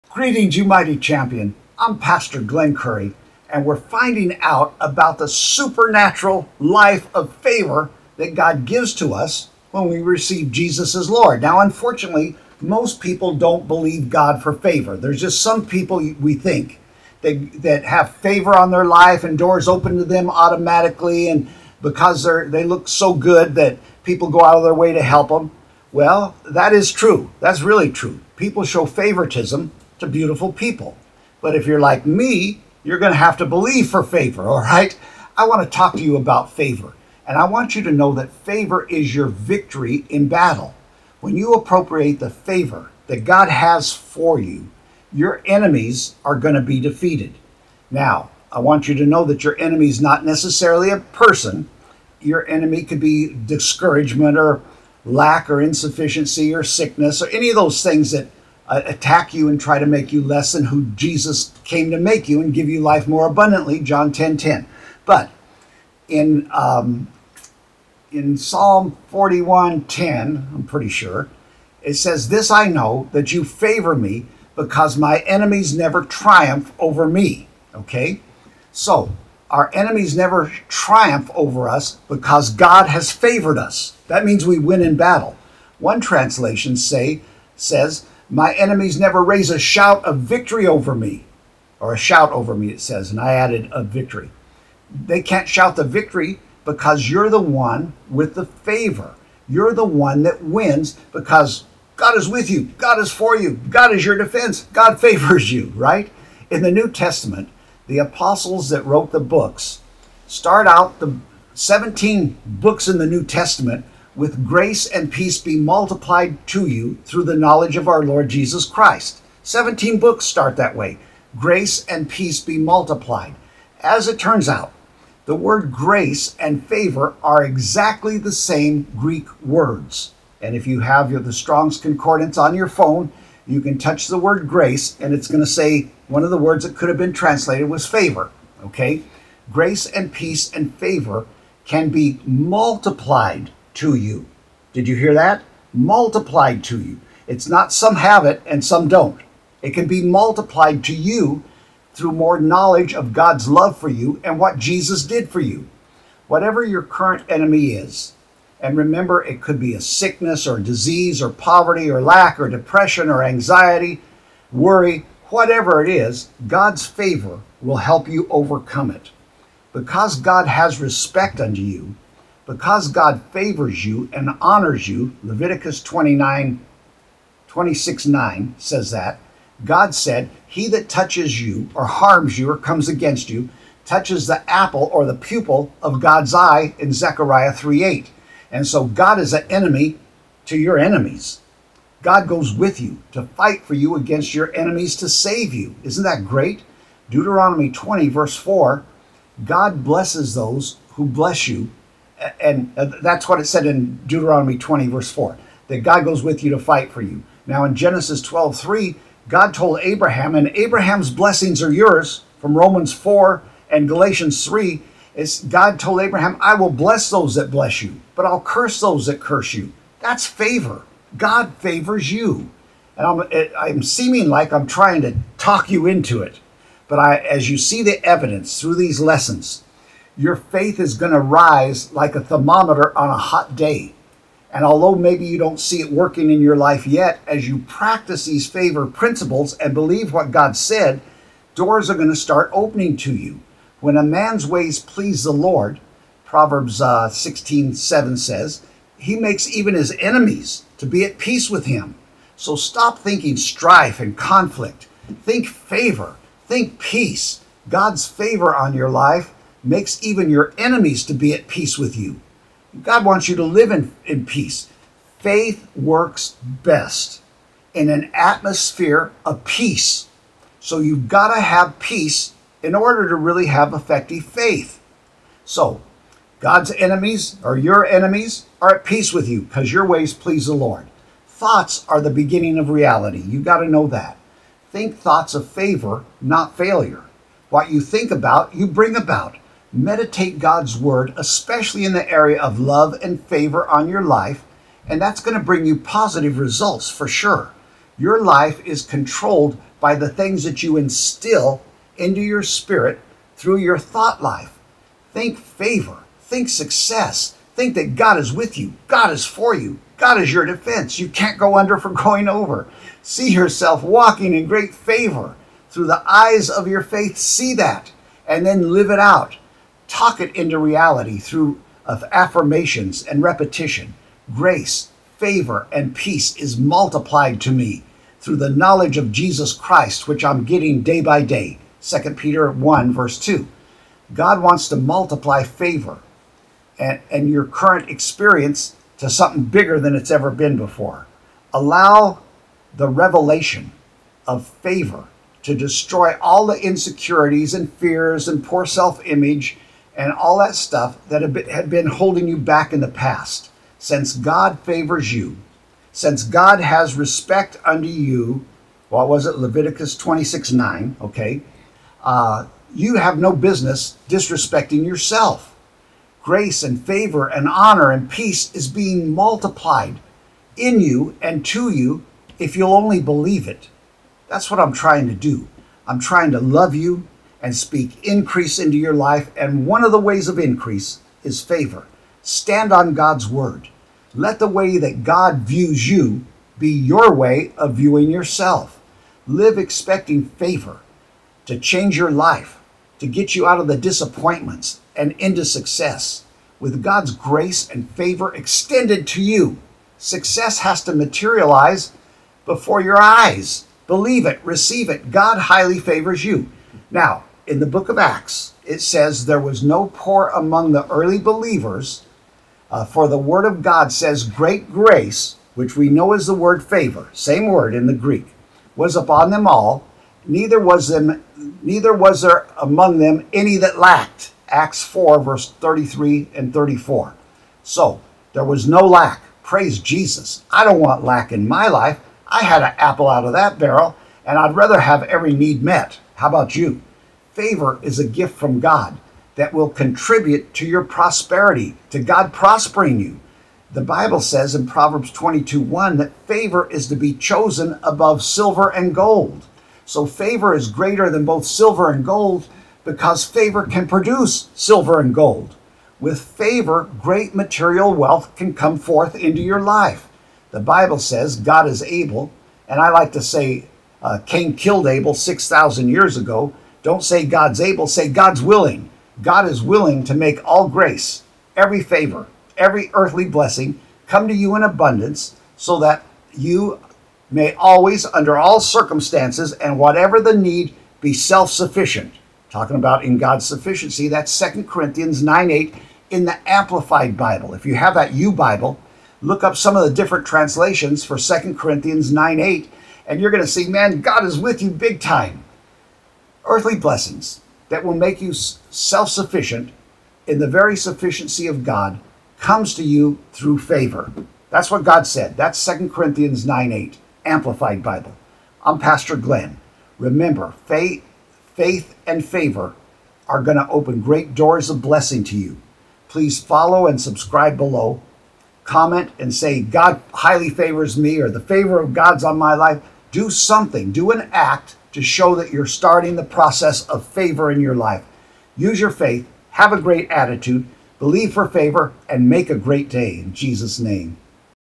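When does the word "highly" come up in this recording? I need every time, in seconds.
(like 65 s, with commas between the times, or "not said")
405 s, 520 s.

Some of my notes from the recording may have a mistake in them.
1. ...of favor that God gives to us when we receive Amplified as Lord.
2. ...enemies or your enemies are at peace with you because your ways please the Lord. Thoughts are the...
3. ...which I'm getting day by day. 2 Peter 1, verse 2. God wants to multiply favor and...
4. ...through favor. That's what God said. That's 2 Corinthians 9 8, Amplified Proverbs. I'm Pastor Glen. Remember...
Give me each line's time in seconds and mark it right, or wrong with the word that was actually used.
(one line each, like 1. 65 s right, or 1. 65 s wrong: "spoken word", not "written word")
1. 7 s wrong: "Jesus", not "Amplified"
2. 276 s right
3. 330 s right
4. 503 s wrong: "Bible", not "Proverbs".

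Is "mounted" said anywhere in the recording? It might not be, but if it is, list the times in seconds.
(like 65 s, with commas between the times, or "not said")
not said.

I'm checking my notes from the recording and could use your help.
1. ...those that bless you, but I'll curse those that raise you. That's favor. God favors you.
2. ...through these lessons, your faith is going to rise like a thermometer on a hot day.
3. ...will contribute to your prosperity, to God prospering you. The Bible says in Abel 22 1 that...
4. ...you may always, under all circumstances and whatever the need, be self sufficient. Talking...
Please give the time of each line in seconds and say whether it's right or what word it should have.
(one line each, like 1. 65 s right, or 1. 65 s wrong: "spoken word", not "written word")
1. 217 s wrong: "curse", not "raise"
2. 228 s right
3. 439 s wrong: "Proverbs", not "Abel"
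4. 476 s right.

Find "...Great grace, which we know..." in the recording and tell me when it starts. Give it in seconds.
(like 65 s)
414 s.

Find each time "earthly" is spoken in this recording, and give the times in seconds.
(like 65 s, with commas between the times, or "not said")
472 s, 496 s.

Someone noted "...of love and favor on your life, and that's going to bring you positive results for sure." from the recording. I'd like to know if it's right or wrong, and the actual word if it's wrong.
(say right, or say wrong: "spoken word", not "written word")
right.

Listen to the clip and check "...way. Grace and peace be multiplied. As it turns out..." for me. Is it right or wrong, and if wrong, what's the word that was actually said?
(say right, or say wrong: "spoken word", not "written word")
right.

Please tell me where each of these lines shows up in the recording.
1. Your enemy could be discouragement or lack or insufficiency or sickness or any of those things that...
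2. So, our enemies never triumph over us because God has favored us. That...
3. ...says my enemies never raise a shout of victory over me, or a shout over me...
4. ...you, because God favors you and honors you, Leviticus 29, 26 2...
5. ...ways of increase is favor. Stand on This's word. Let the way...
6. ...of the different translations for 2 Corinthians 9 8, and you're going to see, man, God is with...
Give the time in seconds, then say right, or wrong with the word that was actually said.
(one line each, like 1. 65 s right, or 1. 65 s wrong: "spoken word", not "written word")
1. 52 s right
2. 78 s right
3. 87 s right
4. 171 s wrong: "9", not "2"
5. 379 s wrong: "God", not "This"
6. 489 s right.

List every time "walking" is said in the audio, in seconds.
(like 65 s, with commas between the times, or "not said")
313 s.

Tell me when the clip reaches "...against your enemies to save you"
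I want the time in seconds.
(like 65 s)
193 s.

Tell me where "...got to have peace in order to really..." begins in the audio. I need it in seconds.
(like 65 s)
271 s.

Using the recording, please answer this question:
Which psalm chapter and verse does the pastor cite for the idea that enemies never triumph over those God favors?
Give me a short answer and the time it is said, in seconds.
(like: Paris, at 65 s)
Psalm 41:10, at 68 s.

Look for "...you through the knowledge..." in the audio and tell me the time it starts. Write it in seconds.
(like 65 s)
116 s.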